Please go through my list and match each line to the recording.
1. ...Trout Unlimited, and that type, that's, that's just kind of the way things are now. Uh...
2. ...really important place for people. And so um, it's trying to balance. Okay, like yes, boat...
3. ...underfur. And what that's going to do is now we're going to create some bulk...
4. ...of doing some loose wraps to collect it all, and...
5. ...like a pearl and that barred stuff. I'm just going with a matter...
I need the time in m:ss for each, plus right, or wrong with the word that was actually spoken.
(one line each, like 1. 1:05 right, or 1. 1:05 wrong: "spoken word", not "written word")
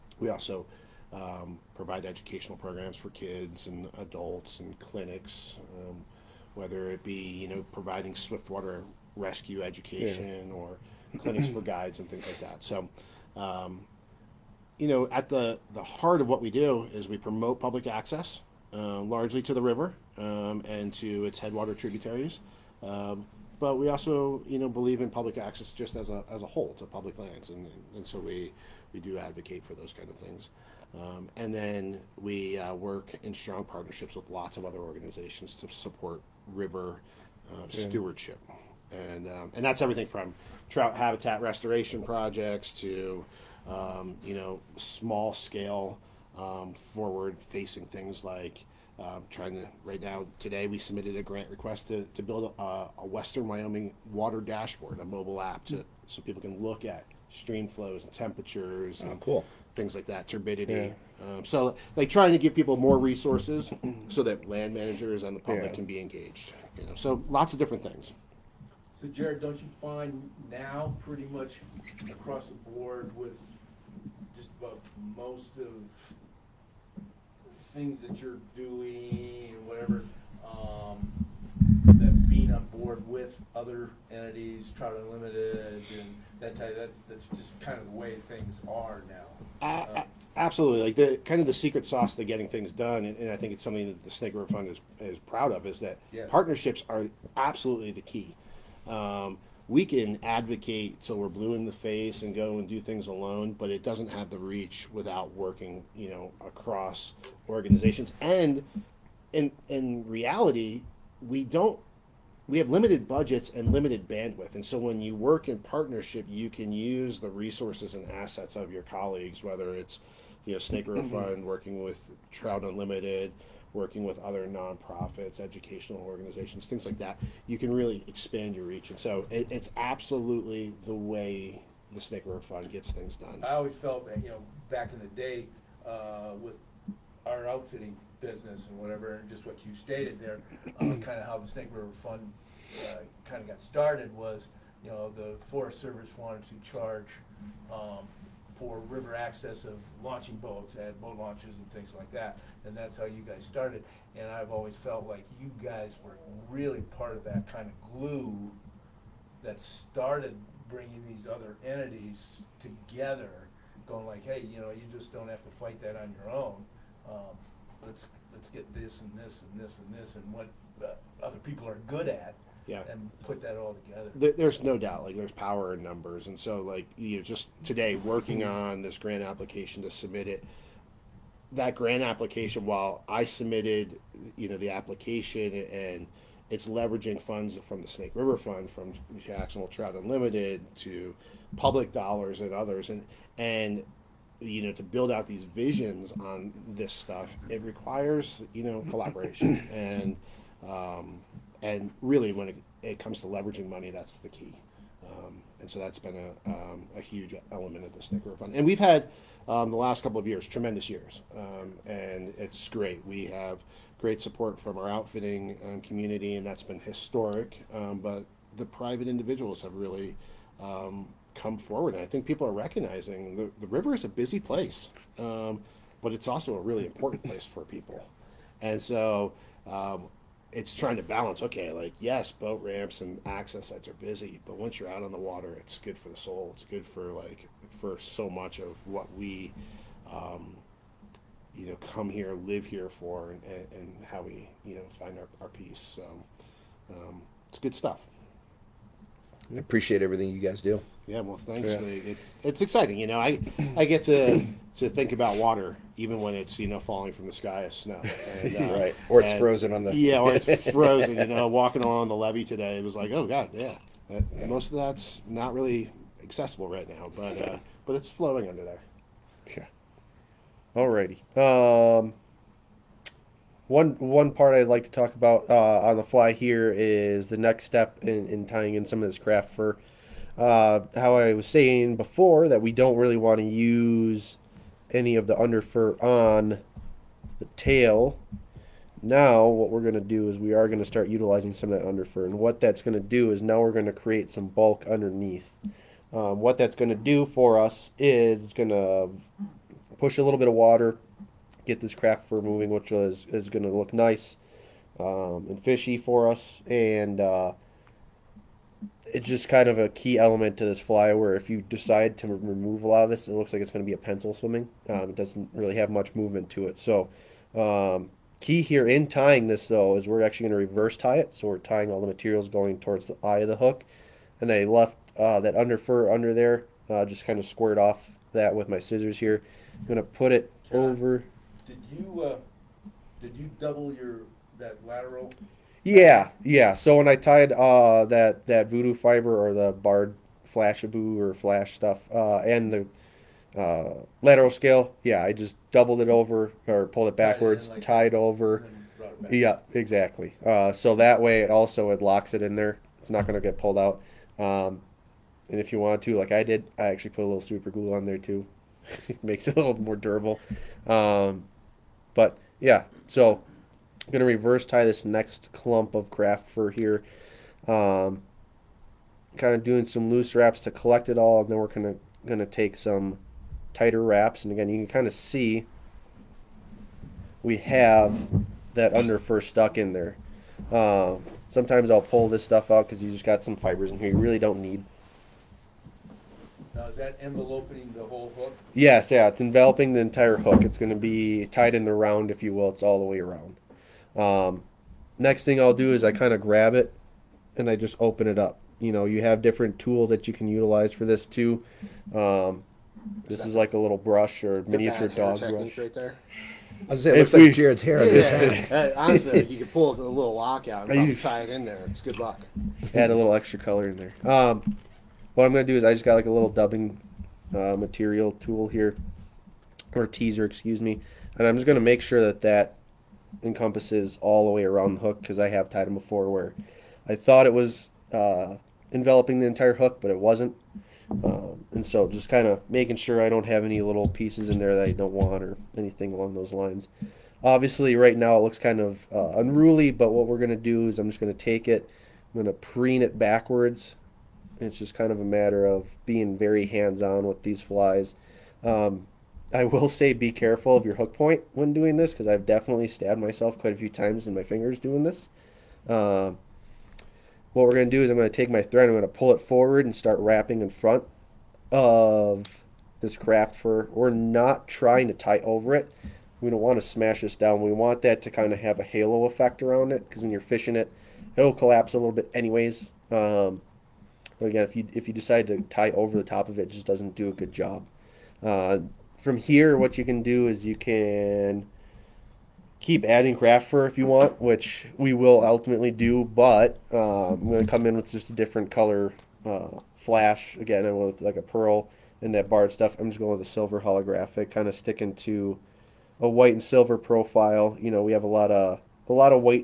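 1. 1:24 right
2. 3:46 right
3. 4:51 right
4. 6:09 right
5. 8:11 wrong: "silver", not "matter".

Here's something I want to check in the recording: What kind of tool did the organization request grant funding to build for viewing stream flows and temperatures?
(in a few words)
Western Wyoming water dashboard.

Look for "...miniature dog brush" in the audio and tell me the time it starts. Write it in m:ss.
6:44.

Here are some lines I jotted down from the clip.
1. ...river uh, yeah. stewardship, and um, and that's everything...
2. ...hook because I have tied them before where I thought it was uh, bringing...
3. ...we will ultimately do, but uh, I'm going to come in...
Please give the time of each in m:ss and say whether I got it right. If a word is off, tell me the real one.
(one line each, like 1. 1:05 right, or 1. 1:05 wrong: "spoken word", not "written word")
1. 0:36 right
2. 7:04 wrong: "enveloping", not "bringing"
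3. 8:04 right.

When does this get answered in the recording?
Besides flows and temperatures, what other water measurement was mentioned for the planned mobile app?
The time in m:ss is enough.
1:00.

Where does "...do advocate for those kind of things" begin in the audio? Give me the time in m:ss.
0:28.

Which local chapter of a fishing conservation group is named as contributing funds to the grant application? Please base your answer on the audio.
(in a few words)
Jacksonville Trout Unlimited.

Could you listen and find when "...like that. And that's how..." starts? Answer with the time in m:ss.
2:31.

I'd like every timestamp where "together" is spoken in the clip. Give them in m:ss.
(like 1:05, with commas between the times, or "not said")
2:42, 2:53.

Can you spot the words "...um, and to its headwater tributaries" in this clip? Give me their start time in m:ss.
0:20.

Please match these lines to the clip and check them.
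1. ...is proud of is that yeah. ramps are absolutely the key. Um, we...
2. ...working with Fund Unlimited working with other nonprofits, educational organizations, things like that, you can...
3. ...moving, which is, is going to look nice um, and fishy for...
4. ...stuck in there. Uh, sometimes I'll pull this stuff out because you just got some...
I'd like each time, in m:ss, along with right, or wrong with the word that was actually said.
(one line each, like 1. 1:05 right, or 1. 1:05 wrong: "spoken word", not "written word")
1. 1:35 wrong: "partnerships", not "ramps"
2. 2:01 wrong: "Trout", not "Fund"
3. 5:02 right
4. 6:19 right.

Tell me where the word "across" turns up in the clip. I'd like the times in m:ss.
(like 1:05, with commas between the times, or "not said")
1:12, 1:46.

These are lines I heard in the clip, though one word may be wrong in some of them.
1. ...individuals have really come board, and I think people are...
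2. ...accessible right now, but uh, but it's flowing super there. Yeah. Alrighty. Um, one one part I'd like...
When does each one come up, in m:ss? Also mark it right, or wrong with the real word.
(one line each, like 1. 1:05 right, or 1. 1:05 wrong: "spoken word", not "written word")
1. 3:39 wrong: "forward", not "board"
2. 4:26 wrong: "under", not "super".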